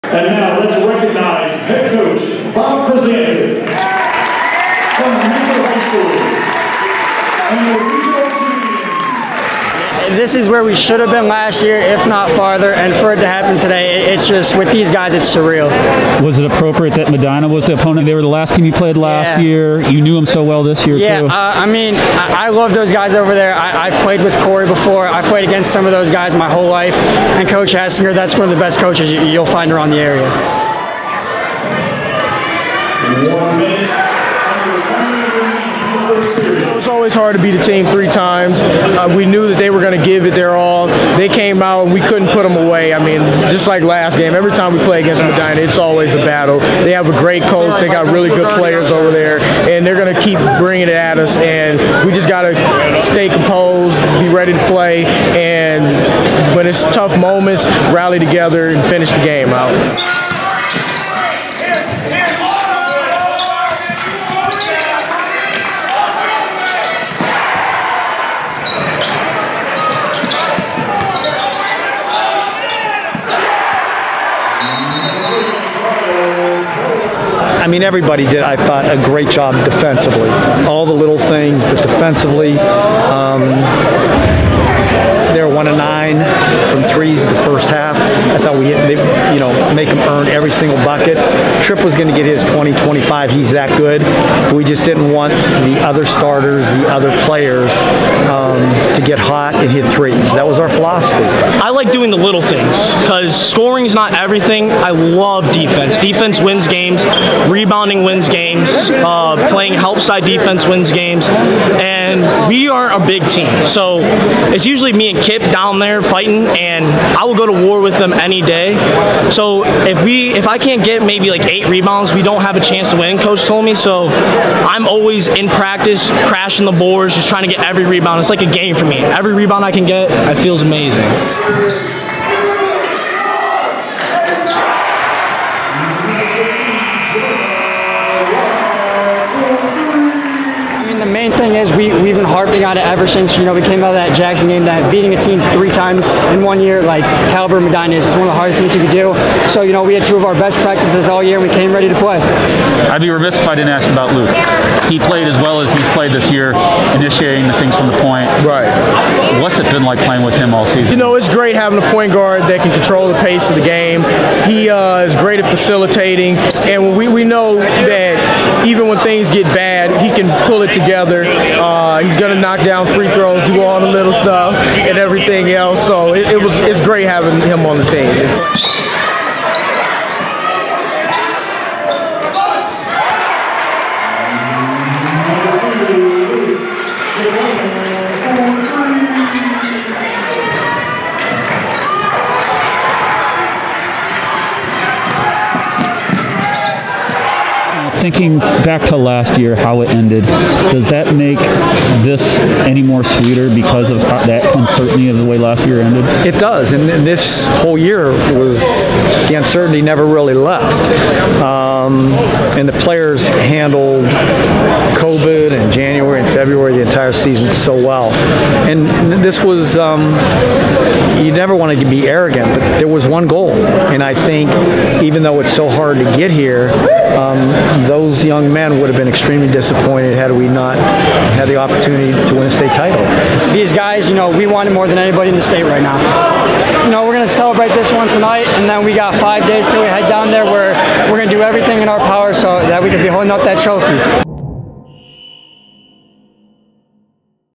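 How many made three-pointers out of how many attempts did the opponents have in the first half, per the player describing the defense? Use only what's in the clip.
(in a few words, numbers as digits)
1 of 9.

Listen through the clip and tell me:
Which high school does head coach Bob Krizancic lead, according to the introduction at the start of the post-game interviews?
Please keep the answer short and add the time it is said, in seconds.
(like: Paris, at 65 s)
Mitchell High School, at 5 s.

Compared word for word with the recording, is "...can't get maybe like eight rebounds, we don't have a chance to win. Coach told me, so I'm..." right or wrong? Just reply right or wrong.
right.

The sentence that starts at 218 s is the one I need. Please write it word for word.
And this was, um, you never wanted to be arrogant, but there was one goal.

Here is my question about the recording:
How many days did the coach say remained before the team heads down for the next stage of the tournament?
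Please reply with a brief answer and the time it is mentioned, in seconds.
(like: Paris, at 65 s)
5, at 239 s.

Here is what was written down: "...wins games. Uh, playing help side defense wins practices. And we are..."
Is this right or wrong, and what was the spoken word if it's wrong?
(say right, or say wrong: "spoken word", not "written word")
wrong: "games", not "practices".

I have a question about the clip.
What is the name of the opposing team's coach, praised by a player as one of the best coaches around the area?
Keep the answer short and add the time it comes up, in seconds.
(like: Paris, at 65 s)
Coach Hassinger, at 27 s.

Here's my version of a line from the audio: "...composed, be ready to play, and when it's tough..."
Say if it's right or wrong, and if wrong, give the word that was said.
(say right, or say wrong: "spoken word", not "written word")
right.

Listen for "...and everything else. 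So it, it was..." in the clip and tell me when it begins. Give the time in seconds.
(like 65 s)
174 s.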